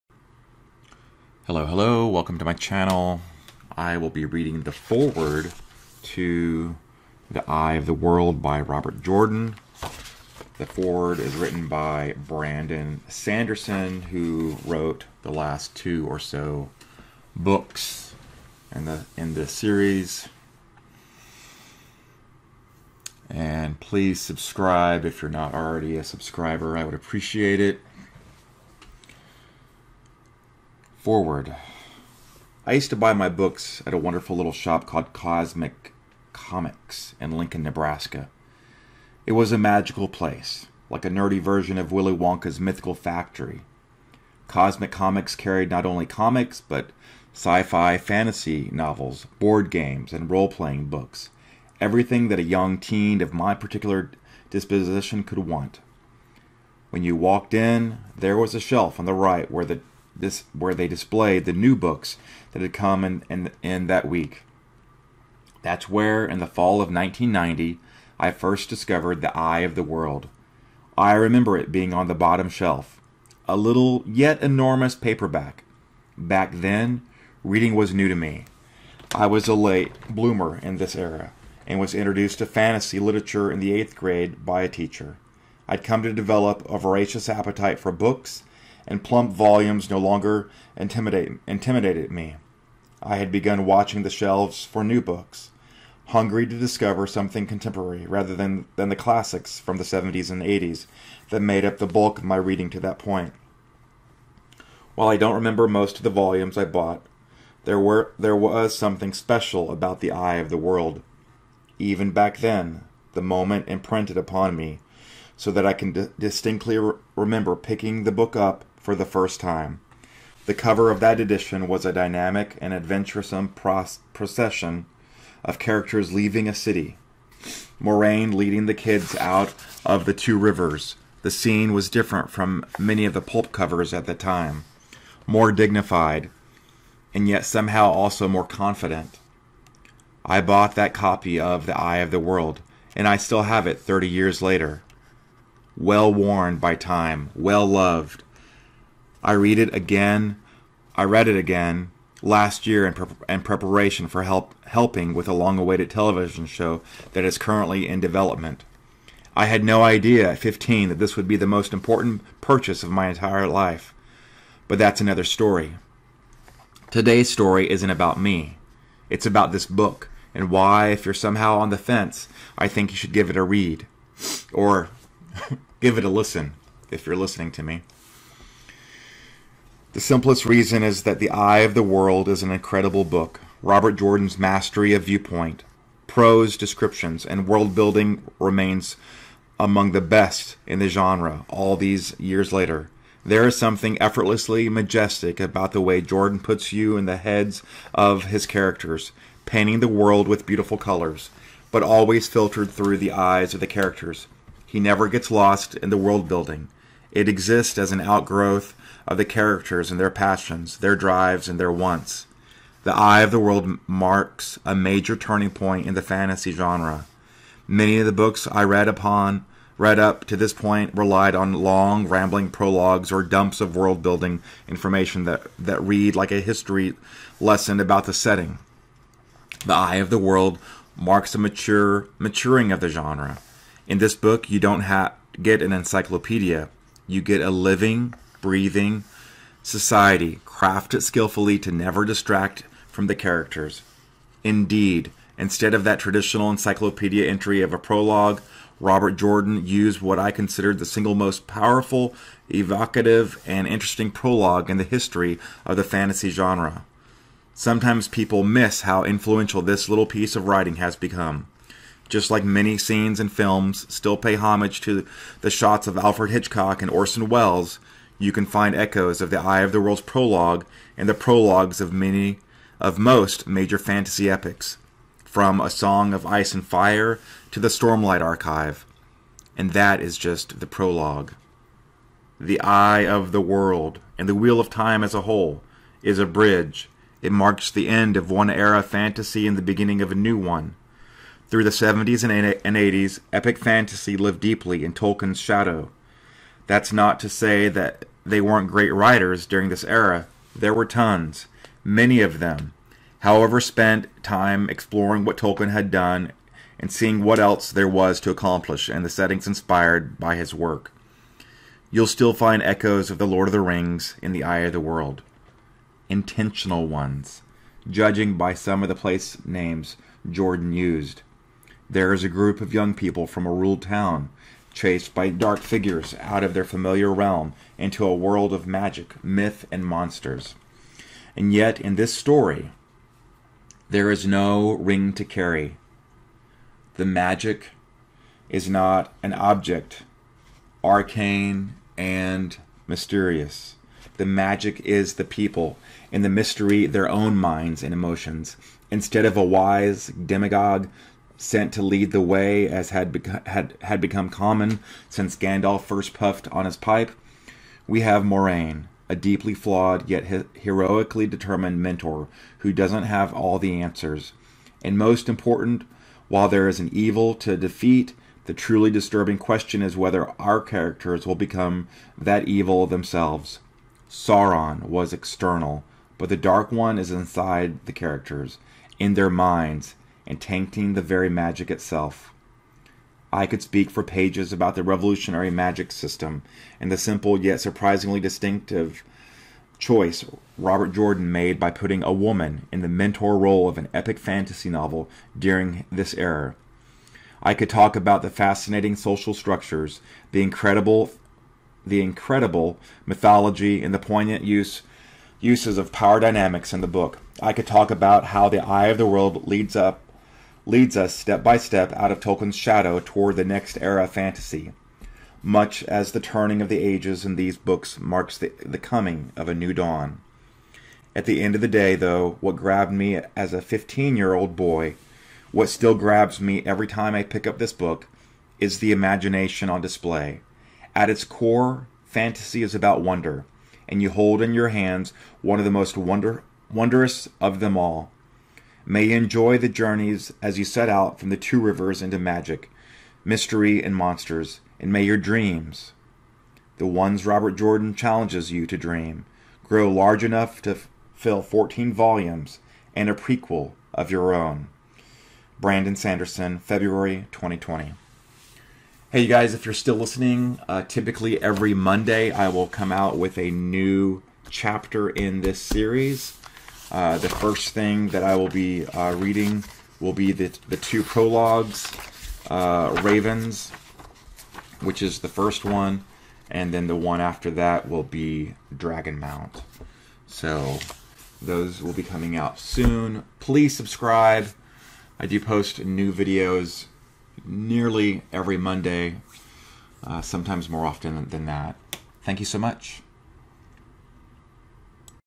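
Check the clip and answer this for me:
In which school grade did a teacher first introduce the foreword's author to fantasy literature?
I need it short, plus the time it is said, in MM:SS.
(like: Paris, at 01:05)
eighth grade, at 01:23.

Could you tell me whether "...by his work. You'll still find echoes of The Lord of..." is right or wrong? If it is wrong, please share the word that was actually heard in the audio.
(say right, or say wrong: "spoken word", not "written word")
right.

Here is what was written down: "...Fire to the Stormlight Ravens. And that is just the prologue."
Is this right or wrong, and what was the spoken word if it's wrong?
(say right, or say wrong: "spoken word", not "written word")
wrong: "Archive", not "Ravens".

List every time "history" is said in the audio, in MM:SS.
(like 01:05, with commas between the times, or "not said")
03:46, 04:14.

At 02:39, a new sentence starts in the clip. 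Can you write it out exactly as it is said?
I had no idea at 15 that this would be the most important purchase of my entire life.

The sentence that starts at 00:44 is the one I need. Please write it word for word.
Cosmic Comics carried not only comics, but sci fi, fantasy novels, board games, and role playing books.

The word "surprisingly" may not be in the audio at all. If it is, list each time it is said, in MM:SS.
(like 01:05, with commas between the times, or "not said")
06:27.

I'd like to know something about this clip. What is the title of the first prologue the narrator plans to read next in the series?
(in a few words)
Ravens.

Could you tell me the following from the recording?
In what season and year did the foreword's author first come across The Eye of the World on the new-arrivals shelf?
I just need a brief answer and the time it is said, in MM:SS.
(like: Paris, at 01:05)
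fall of 1990, at 01:06.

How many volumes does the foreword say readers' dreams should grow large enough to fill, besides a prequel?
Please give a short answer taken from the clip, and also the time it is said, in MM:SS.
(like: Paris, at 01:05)
14, at 07:31.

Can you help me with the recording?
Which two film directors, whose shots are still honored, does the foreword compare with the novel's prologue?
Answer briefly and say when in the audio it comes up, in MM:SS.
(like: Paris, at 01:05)
Alfred Hitchcock and Orson Welles, at 04:25.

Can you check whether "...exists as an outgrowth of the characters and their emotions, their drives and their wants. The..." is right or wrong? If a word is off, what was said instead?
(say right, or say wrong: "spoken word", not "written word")
wrong: "passions", not "emotions".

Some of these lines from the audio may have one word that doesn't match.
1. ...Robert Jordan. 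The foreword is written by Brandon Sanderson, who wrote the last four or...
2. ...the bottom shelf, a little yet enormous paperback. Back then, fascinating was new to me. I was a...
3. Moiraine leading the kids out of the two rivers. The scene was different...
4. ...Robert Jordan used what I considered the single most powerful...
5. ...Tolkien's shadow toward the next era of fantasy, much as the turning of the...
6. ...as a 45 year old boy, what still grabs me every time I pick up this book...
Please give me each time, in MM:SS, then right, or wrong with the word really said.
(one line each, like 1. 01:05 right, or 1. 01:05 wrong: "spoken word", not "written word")
1. 00:08 wrong: "two", not "four"
2. 01:12 wrong: "reading", not "fascinating"
3. 02:07 right
4. 04:08 right
5. 06:52 right
6. 07:03 wrong: "15", not "45".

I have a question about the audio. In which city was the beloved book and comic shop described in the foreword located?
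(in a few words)
Lincoln, Nebraska.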